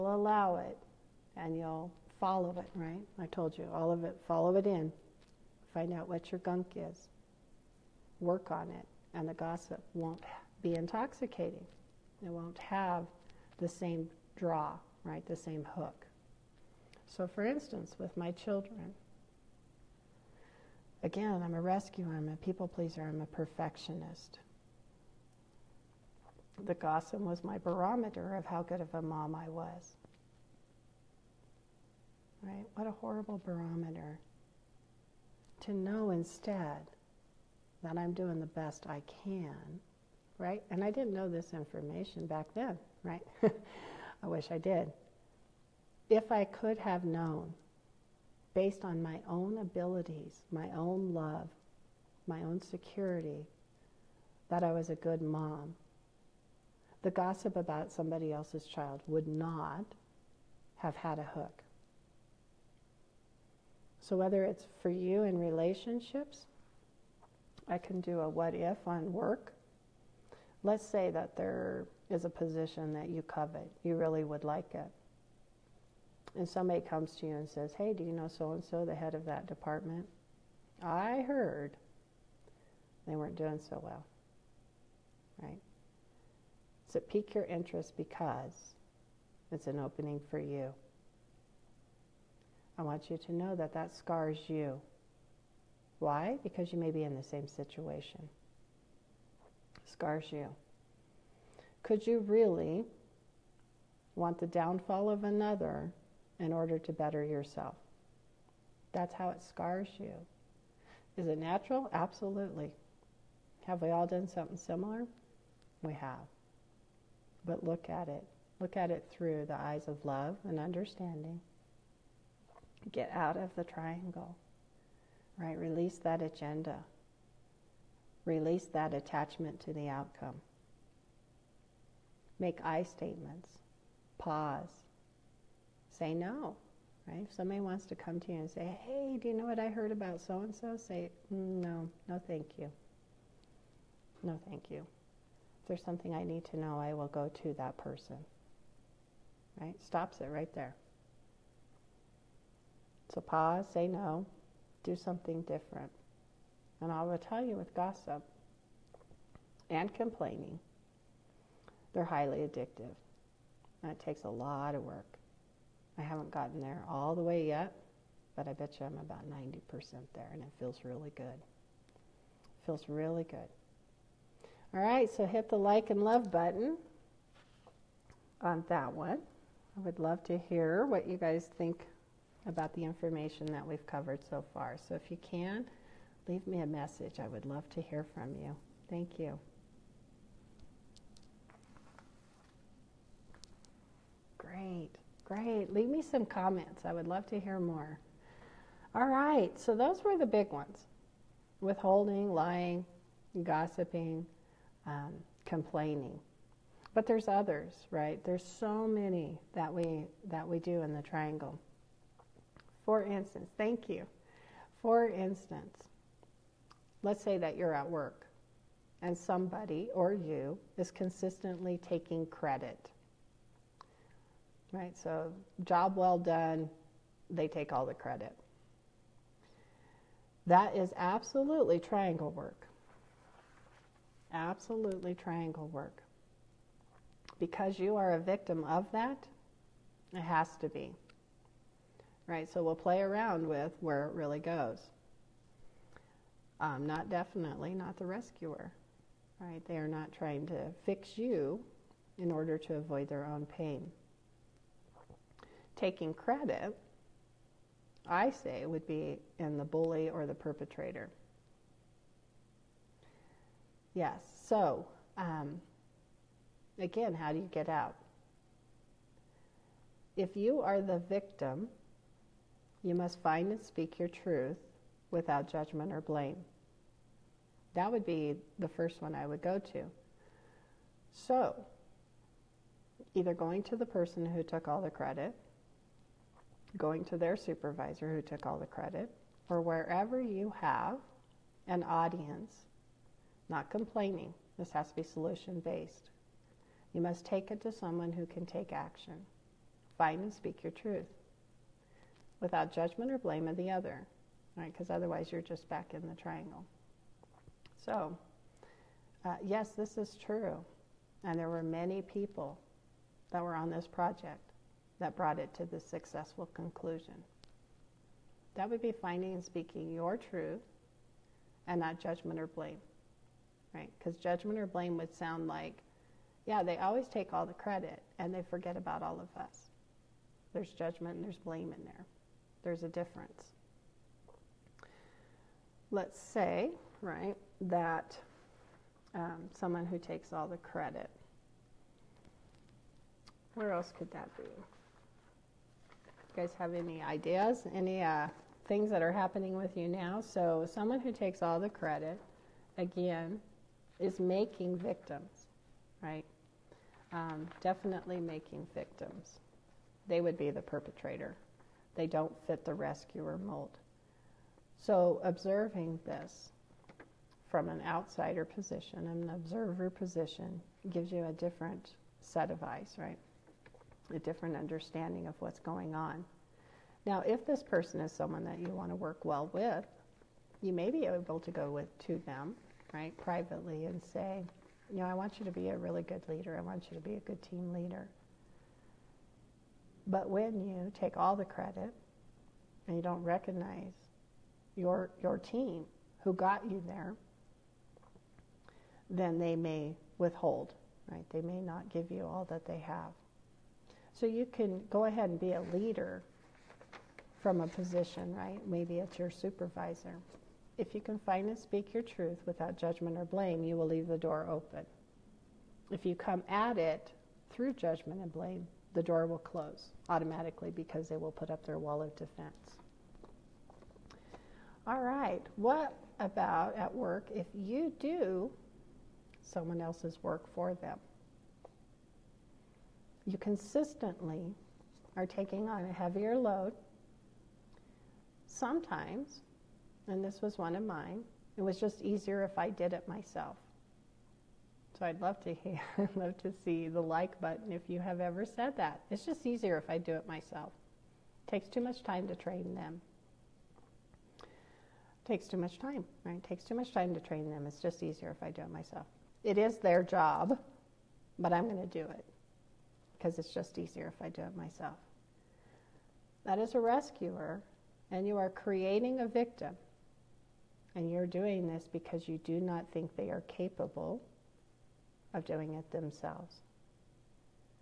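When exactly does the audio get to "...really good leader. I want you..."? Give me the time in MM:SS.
06:25.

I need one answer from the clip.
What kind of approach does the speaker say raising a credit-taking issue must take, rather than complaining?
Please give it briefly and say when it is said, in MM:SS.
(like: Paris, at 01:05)
solution based, at 04:55.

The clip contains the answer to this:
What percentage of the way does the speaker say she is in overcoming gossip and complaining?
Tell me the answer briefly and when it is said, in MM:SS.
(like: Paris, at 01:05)
90%, at 02:49.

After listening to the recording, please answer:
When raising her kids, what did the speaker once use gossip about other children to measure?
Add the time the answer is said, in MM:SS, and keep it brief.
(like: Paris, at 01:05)
how good of a mom I was, at 00:28.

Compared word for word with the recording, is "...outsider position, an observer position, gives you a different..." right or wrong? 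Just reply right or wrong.
right.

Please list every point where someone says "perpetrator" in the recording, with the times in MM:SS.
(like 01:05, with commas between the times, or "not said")
04:20, 06:00.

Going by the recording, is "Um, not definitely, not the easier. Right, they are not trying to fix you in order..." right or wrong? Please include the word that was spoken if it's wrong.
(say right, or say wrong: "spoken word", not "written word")
wrong: "rescuer", not "easier".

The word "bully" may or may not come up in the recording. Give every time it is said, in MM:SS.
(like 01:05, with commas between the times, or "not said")
04:19.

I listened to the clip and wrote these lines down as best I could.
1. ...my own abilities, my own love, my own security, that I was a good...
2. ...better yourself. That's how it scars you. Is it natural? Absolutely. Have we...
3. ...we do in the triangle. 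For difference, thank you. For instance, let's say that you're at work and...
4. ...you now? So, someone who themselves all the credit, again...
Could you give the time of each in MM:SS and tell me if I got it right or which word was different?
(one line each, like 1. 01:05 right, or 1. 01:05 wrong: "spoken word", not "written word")
1. 00:49 right
2. 01:46 right
3. 03:30 wrong: "instance", not "difference"
4. 05:49 wrong: "takes", not "themselves".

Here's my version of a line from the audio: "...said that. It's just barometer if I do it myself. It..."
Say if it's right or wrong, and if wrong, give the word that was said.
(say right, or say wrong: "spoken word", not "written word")
wrong: "easier", not "barometer".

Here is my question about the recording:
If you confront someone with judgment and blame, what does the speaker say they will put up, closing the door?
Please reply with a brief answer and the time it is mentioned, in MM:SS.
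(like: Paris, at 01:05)
wall of defense, at 07:01.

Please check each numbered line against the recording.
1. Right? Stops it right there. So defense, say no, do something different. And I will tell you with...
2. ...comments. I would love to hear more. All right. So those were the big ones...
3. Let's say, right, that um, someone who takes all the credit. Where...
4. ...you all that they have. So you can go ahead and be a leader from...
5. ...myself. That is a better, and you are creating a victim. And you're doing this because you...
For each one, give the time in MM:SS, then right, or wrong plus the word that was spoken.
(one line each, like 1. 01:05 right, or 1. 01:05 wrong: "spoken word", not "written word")
1. 02:29 wrong: "pause", not "defense"
2. 03:16 right
3. 05:35 right
4. 06:42 right
5. 07:44 wrong: "rescuer", not "better".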